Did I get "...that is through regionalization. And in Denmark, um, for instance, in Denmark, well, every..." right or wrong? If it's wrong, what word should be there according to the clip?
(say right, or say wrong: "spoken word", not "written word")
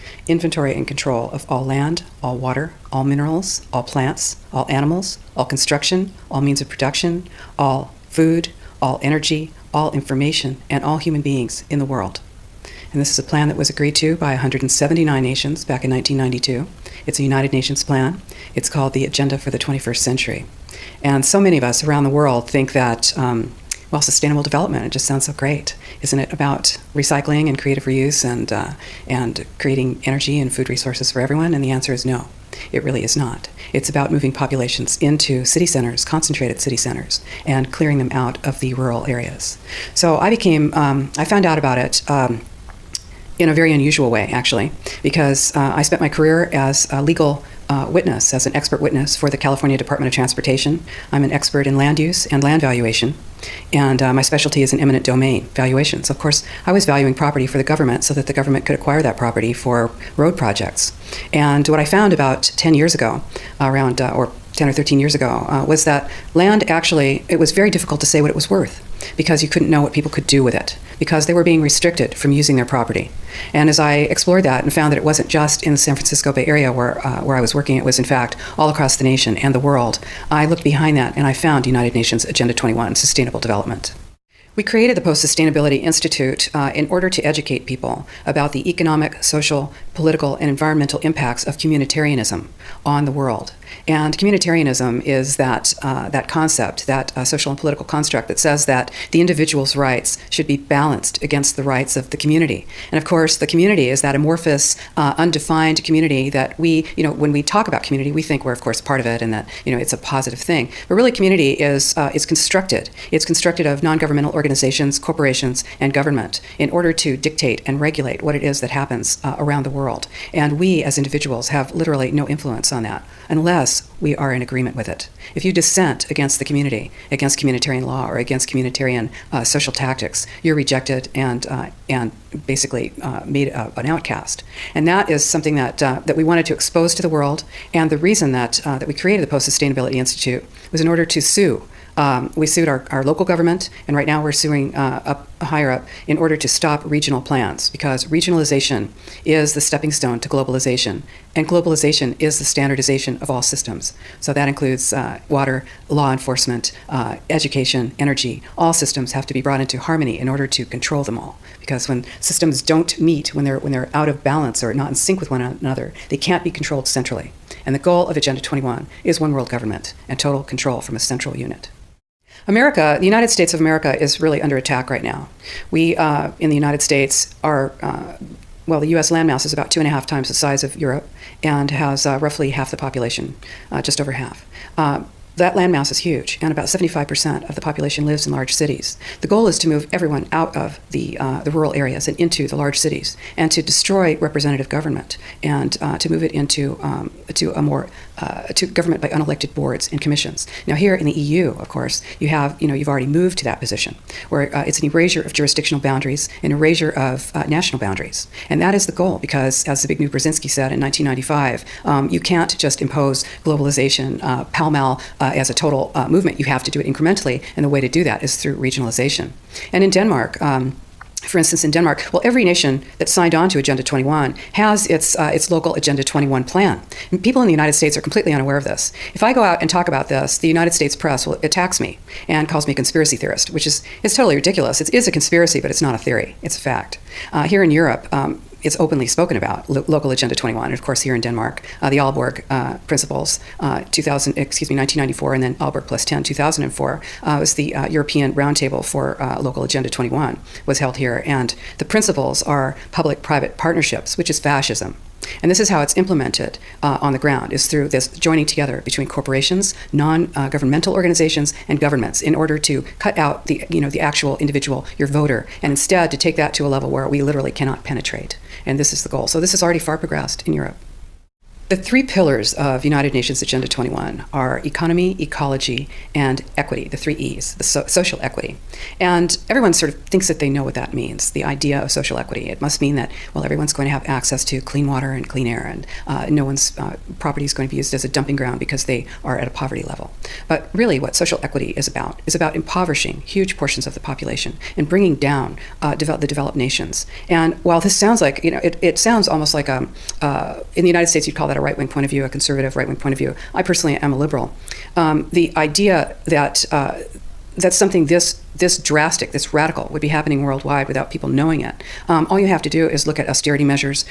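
right.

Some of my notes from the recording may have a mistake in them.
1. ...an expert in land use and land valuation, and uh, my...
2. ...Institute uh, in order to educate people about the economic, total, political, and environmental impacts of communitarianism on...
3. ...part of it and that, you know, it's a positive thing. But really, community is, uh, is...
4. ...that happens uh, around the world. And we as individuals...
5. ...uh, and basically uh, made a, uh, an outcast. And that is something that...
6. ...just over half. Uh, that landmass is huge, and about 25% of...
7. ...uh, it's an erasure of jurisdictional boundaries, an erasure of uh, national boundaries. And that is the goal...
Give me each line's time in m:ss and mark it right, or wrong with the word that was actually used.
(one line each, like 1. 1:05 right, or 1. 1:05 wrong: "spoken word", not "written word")
1. 0:51 right
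2. 1:25 wrong: "social", not "total"
3. 1:48 right
4. 1:58 right
5. 2:11 right
6. 3:03 wrong: "75", not "25"
7. 3:24 right.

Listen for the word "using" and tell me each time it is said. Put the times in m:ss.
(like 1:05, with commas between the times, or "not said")
1:12.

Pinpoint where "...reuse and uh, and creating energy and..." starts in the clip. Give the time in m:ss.
0:27.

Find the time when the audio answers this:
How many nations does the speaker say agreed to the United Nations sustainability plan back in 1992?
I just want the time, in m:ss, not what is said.
0:14.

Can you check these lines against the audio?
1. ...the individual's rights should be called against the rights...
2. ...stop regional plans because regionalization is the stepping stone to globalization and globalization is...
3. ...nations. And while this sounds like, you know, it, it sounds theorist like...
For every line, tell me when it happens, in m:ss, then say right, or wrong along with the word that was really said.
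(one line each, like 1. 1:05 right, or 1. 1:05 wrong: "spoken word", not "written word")
1. 1:39 wrong: "balanced", not "called"
2. 2:26 right
3. 4:56 wrong: "almost", not "theorist".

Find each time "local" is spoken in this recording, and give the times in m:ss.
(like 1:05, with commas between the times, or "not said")
2:23, 3:45, 3:59, 4:09.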